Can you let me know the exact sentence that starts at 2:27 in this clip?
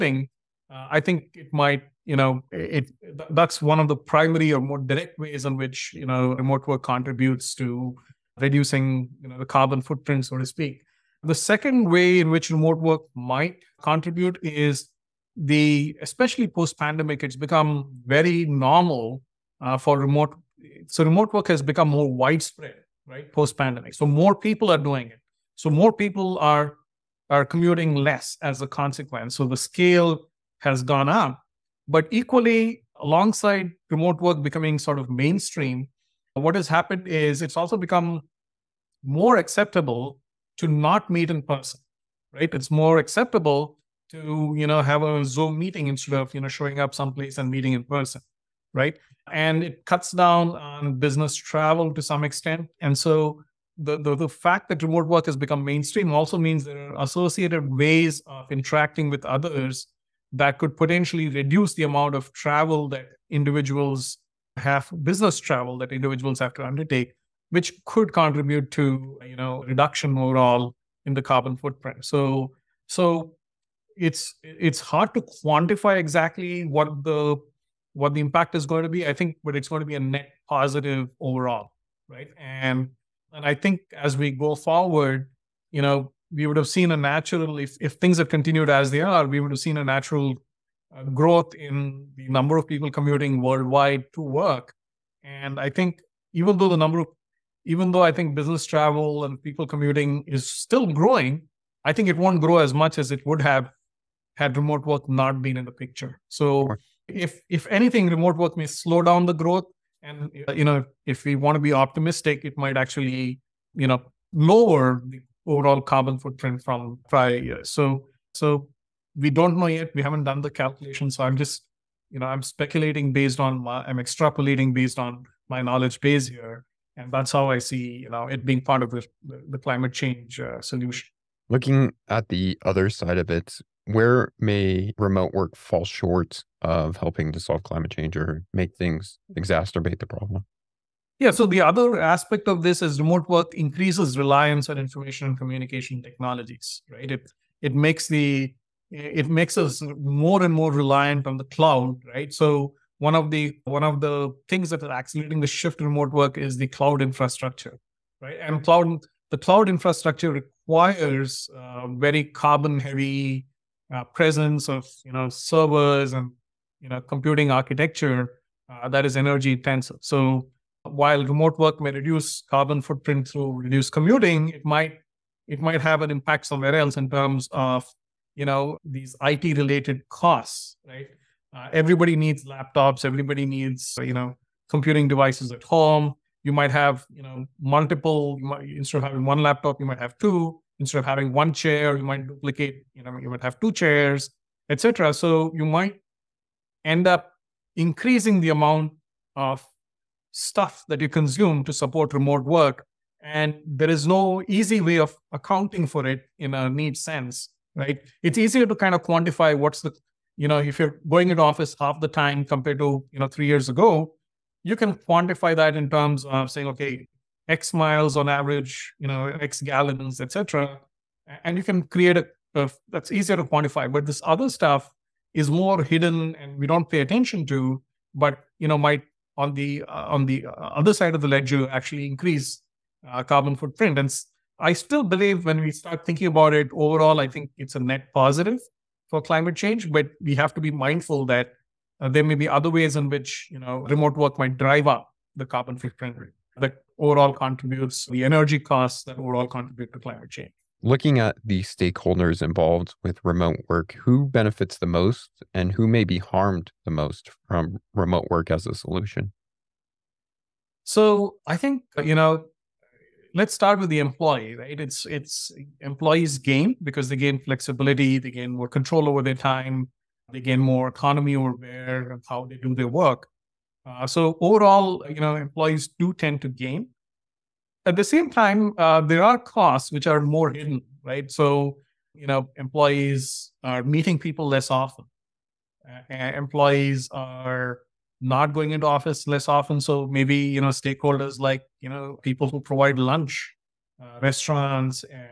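It it makes the it makes us more and more reliant on the cloud, right?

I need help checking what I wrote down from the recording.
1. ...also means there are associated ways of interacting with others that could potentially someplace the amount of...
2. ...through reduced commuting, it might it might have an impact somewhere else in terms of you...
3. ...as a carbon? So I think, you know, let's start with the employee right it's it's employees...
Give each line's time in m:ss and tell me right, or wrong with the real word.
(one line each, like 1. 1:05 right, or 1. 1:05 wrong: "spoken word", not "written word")
1. 0:56 wrong: "reduce", not "someplace"
2. 2:53 right
3. 4:18 wrong: "solution", not "carbon".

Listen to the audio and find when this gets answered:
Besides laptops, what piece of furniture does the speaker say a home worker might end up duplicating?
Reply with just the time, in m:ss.
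3:13.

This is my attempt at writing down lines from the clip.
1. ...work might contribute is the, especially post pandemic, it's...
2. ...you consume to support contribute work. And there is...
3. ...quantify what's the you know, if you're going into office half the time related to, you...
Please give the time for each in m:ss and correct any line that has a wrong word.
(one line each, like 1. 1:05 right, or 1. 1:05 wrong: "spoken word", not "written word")
1. 0:12 right
2. 3:21 wrong: "remote", not "contribute"
3. 3:29 wrong: "compared", not "related".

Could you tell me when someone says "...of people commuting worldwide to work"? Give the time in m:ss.
1:32.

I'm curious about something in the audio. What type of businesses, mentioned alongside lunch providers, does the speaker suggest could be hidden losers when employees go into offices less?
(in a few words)
restaurants.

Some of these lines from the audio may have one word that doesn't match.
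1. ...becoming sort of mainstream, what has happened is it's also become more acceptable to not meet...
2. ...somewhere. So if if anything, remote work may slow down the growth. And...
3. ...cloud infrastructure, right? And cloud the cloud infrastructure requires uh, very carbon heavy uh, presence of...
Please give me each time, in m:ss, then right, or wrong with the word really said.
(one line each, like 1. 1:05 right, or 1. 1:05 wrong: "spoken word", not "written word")
1. 0:34 right
2. 1:45 wrong: "picture", not "somewhere"
3. 2:36 right.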